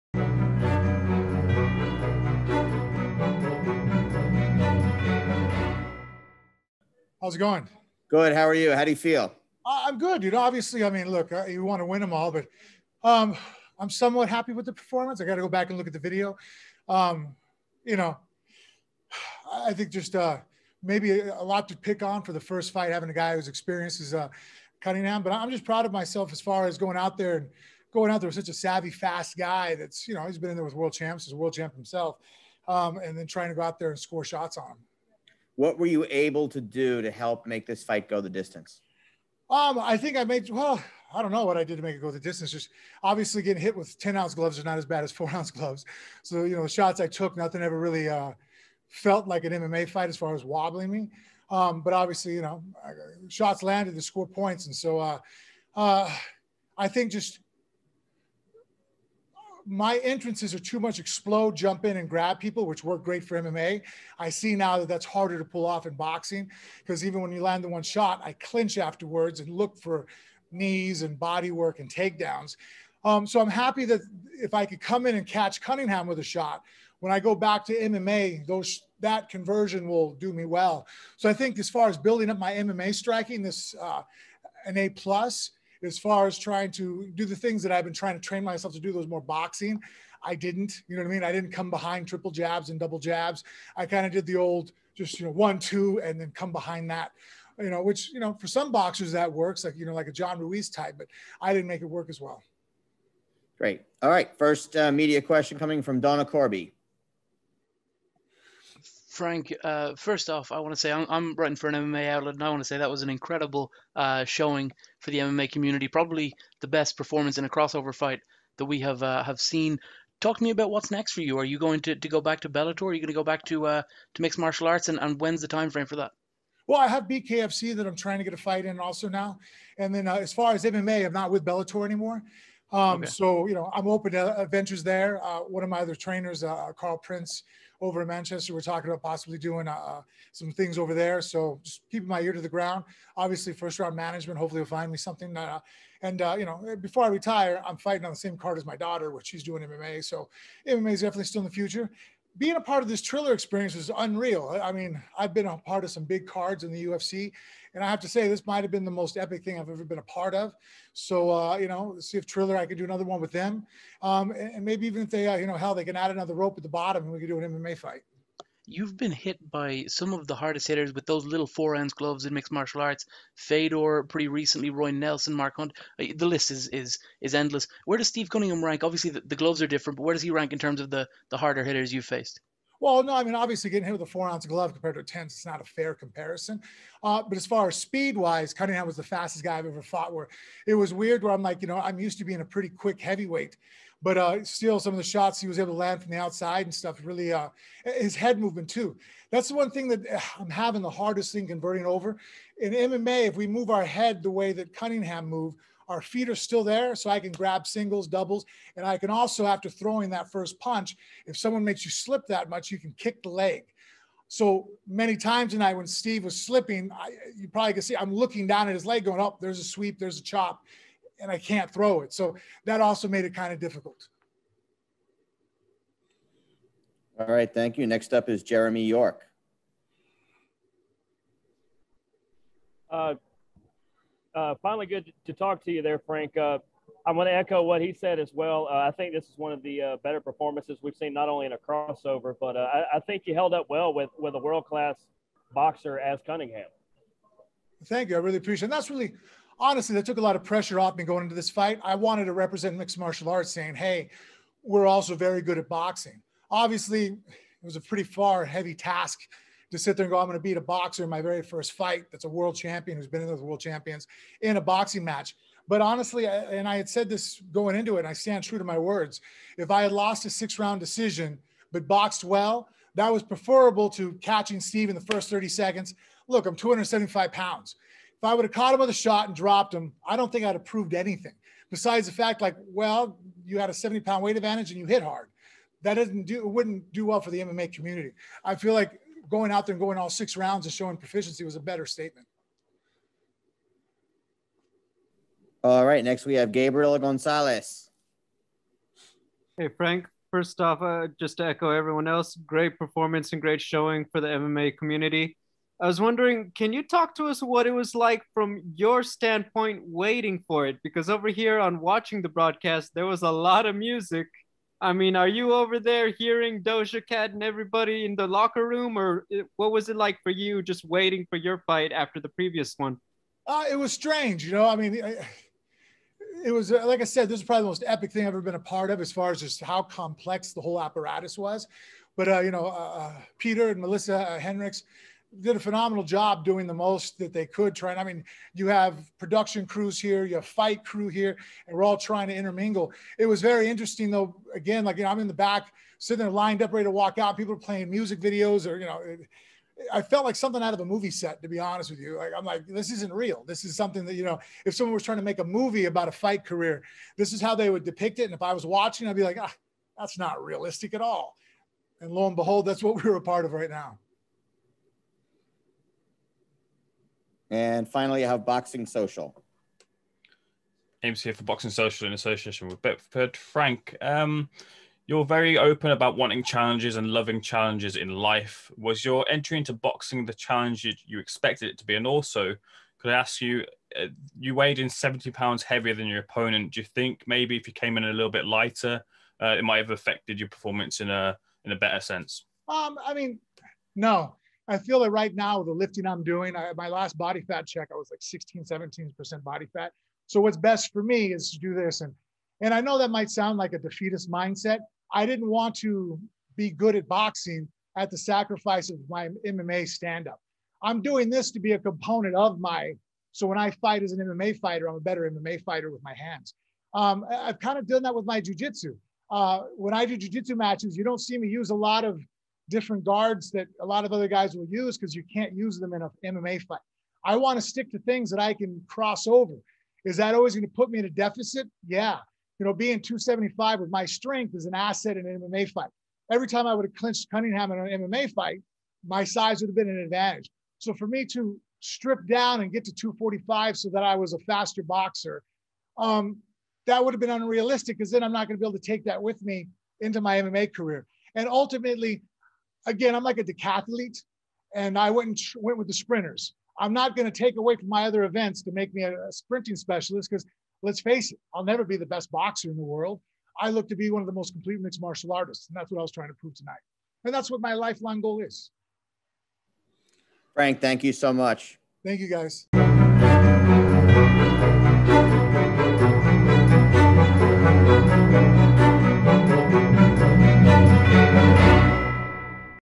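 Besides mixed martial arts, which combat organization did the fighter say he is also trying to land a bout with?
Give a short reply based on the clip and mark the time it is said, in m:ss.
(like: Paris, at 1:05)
BKFC, at 2:07.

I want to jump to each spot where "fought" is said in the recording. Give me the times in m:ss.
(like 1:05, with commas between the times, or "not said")
3:09.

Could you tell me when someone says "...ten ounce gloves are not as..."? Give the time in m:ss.
0:43.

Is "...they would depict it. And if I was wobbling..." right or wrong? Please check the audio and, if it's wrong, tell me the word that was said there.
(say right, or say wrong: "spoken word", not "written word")
wrong: "watching", not "wobbling".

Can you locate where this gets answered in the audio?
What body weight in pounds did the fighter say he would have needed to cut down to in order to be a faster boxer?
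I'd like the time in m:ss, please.
7:22.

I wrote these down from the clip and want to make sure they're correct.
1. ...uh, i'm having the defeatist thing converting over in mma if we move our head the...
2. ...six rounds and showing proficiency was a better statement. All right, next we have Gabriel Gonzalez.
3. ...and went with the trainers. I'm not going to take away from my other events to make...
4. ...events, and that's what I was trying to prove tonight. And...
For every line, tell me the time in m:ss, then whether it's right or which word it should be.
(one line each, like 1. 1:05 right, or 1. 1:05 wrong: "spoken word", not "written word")
1. 3:20 wrong: "hardest", not "defeatist"
2. 4:50 right
3. 7:35 wrong: "sprinters", not "trainers"
4. 7:45 wrong: "artists", not "events".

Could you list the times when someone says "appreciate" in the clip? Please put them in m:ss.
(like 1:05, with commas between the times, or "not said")
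4:08.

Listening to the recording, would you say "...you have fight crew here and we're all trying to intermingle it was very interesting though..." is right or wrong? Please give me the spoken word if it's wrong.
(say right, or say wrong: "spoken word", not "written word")
right.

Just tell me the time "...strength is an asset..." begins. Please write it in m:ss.
7:14.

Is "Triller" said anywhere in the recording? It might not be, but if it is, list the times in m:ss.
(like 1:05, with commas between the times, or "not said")
2:33, 2:42.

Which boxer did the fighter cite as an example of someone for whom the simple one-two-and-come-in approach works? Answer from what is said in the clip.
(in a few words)
John Ruiz.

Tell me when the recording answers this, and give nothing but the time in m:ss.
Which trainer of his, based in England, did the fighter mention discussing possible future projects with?
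2:16.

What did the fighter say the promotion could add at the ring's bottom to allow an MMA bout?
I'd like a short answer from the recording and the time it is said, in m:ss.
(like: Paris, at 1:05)
Another rope, at 2:46.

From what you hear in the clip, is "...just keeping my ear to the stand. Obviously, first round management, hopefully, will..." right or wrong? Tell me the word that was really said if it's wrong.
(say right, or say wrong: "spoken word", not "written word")
wrong: "ground", not "stand".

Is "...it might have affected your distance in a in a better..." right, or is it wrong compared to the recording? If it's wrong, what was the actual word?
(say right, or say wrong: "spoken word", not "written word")
wrong: "performance", not "distance".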